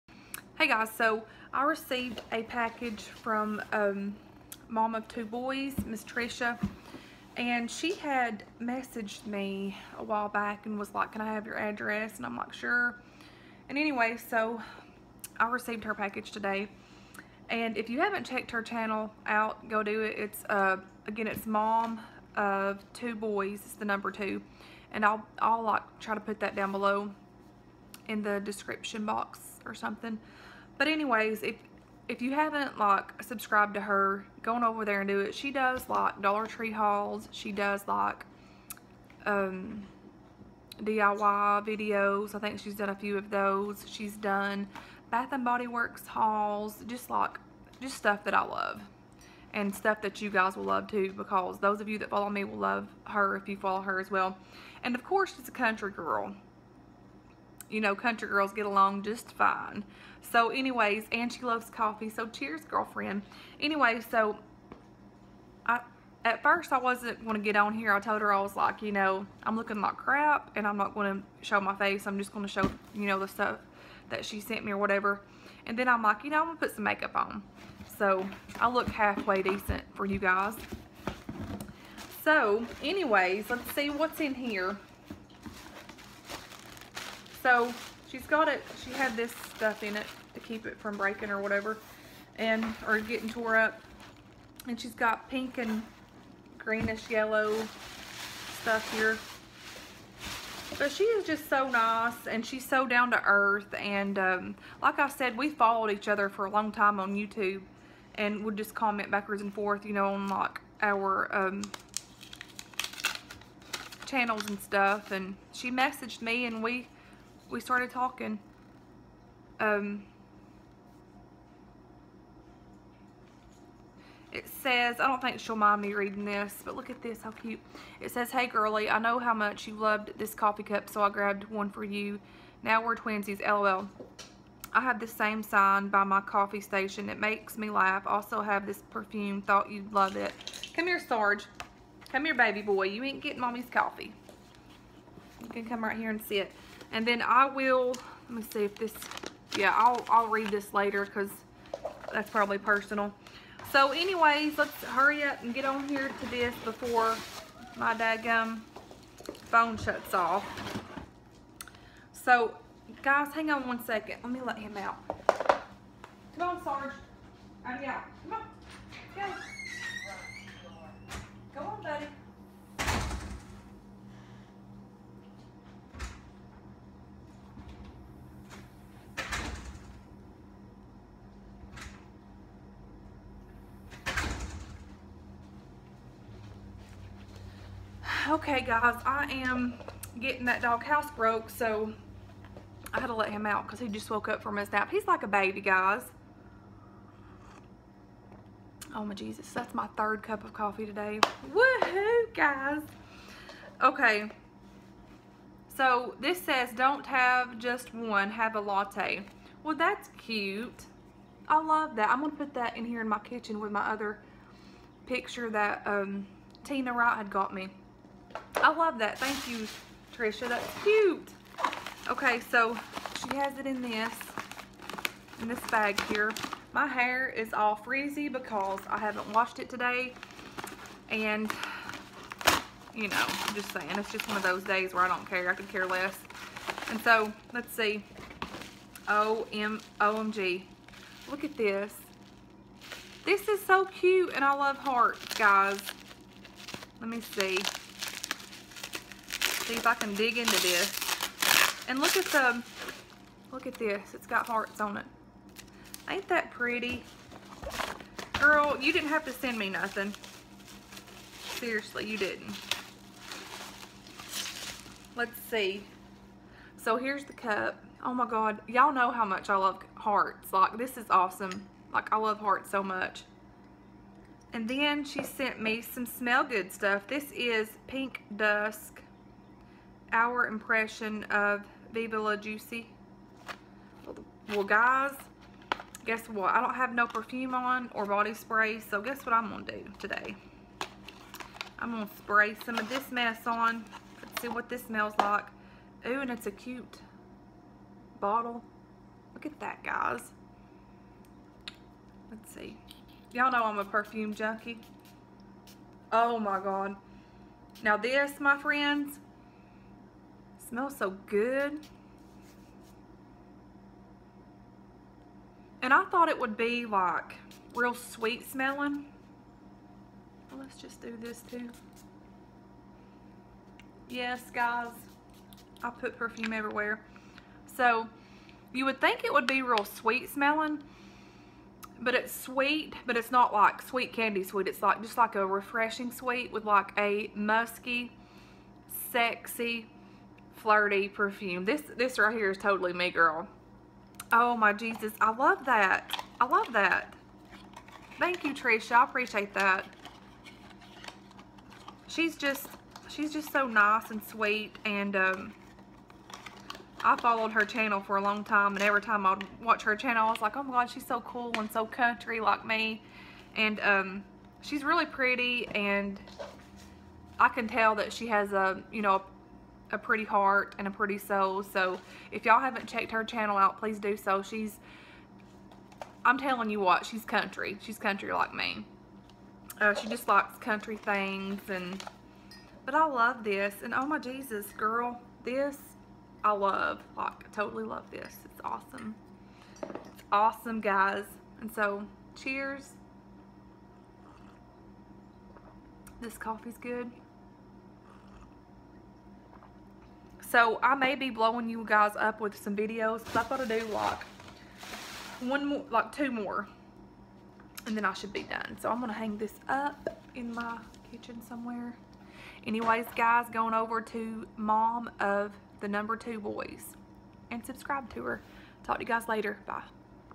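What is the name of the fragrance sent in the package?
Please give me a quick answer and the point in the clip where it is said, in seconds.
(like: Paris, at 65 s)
Pink Dusk, at 277 s.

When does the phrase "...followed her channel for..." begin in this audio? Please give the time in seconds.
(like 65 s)
357 s.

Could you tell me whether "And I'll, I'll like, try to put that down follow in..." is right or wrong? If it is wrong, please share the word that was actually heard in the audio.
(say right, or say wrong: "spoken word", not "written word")
wrong: "below", not "follow".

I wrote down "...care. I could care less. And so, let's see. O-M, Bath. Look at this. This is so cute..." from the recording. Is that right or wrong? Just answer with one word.
wrong.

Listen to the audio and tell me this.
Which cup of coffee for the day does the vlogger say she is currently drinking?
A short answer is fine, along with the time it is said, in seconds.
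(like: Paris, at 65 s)
third, at 199 s.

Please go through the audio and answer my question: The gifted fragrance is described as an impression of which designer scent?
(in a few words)
Viva La Juicy.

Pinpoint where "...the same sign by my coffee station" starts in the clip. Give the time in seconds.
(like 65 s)
135 s.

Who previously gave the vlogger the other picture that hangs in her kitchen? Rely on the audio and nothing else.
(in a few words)
Tina Wright.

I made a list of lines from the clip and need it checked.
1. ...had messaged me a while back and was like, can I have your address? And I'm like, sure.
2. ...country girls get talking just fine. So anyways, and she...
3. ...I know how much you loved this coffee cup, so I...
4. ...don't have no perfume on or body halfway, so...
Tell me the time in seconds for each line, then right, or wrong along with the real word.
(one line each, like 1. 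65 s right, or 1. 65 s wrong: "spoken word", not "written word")
1. 7 s right
2. 57 s wrong: "along", not "talking"
3. 128 s right
4. 286 s wrong: "spray", not "halfway".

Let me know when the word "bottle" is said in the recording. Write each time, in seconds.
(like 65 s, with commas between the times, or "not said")
298 s.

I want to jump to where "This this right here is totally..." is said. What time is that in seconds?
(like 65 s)
341 s.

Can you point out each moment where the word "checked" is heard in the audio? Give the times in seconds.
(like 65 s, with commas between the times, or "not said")
18 s, 372 s.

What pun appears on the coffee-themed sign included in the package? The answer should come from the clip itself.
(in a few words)
Don't have just one, have a latte.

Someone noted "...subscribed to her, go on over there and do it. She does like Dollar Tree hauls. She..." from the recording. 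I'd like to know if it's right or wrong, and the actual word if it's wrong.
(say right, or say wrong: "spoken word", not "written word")
right.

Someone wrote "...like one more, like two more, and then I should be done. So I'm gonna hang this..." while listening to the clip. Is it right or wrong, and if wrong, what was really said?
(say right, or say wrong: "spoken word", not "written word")
right.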